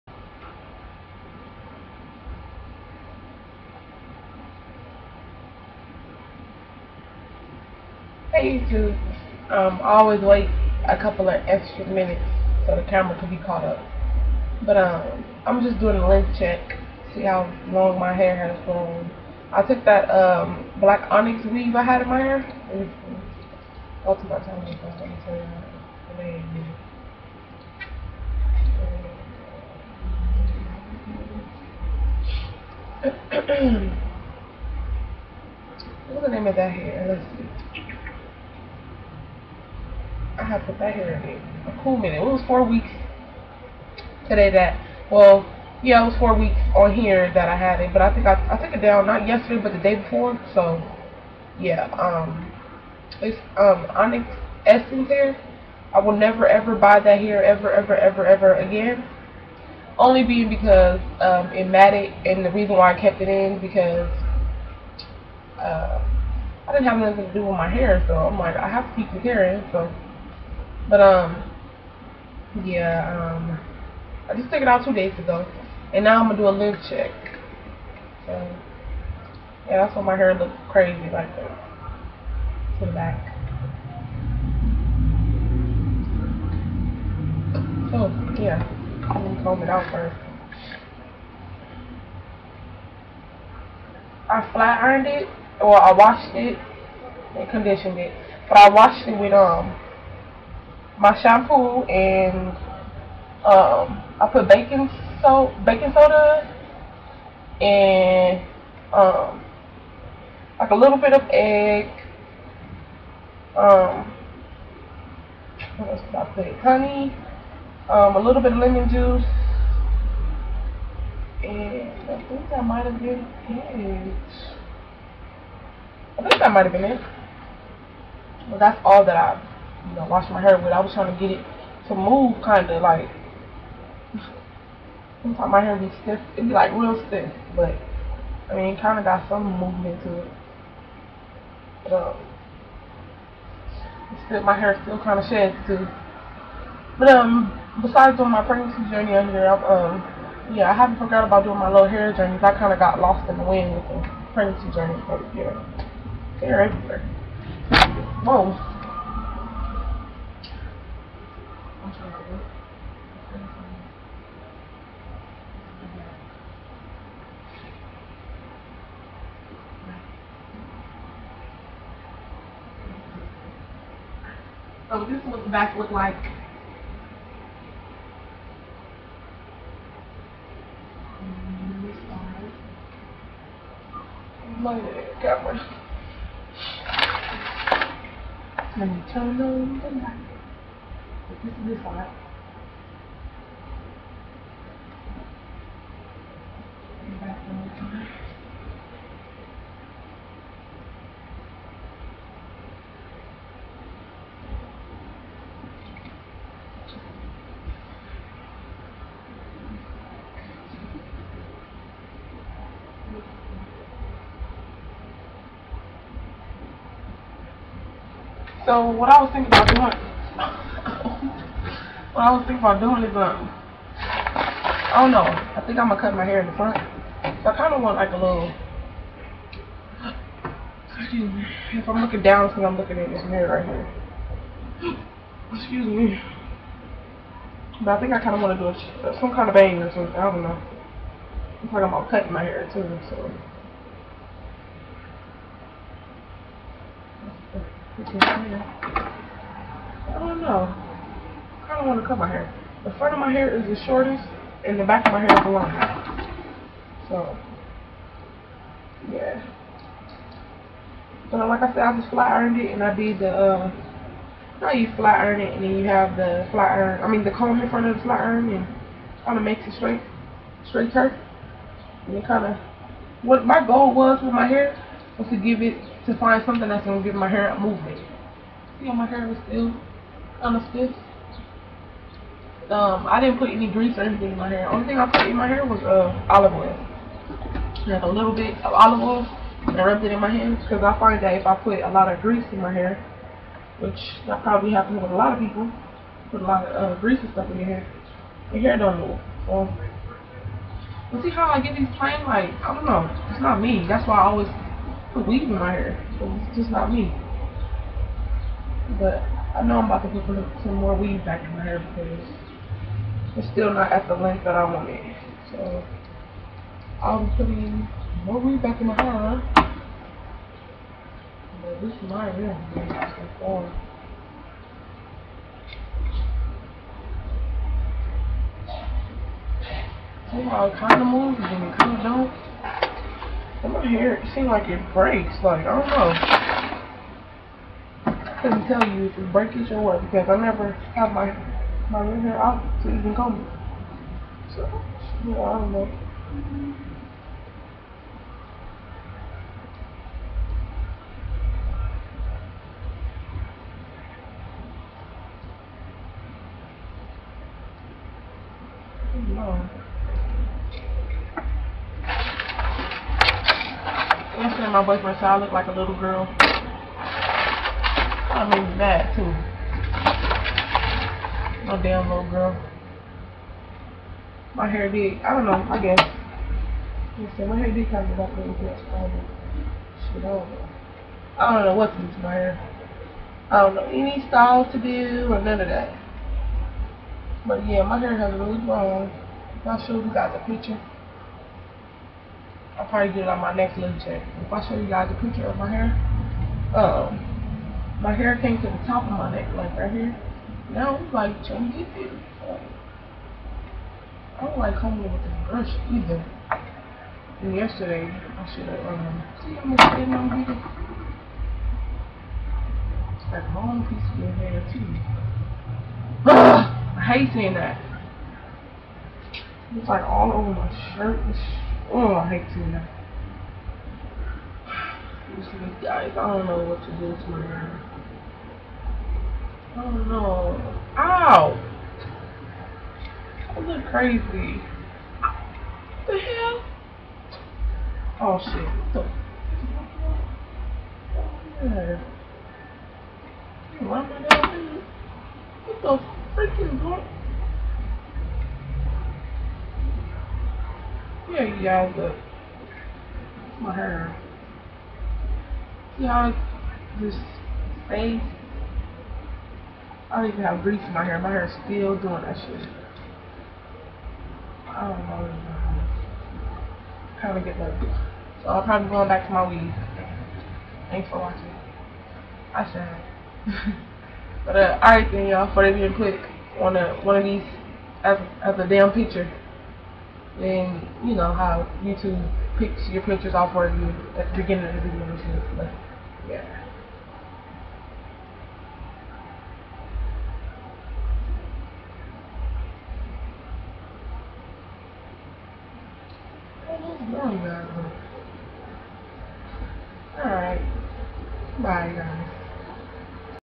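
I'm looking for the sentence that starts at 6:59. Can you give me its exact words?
It's like all over my shirt Oh, I hate tuna.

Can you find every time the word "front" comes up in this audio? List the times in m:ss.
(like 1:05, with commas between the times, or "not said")
3:46, 4:12, 4:27.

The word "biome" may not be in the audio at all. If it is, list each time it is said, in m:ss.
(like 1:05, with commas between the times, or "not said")
not said.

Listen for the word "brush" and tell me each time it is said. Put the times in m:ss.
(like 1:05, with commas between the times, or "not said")
6:45.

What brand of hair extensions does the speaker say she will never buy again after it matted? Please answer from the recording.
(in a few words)
Onyx Essence.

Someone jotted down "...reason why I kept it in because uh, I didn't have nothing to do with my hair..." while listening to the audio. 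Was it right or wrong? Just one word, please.
right.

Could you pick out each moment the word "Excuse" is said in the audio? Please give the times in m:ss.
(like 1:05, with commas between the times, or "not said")
3:50, 3:55.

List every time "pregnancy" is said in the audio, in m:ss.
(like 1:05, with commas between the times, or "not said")
2:28, 2:34.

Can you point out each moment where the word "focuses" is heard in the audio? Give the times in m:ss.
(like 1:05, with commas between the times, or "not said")
not said.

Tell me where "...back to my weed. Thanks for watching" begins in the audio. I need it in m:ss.
7:49.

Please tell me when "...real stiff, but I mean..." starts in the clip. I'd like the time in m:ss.
2:16.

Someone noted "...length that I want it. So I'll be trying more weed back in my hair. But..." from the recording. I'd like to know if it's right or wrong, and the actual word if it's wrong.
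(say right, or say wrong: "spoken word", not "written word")
wrong: "putting", not "trying".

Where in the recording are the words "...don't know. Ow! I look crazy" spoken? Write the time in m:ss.
7:09.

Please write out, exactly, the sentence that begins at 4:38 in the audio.
You know, my hair was still kind of stiff.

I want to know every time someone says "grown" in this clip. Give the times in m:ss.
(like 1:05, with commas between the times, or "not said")
0:18, 6:28.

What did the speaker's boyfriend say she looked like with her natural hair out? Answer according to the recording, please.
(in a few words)
a little girl.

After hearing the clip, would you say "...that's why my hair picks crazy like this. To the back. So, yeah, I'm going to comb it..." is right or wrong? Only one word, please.
wrong.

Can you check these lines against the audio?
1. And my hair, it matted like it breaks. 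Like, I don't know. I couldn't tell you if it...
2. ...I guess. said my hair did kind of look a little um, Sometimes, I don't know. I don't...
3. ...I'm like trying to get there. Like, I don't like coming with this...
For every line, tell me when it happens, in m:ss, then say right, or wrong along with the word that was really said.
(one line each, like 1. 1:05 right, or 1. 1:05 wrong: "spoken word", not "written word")
1. 5:33 wrong: "seemed", not "matted"
2. 6:15 wrong: "Shit", not "Sometimes"
3. 6:40 right.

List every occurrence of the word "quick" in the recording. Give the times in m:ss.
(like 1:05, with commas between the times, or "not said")
7:55.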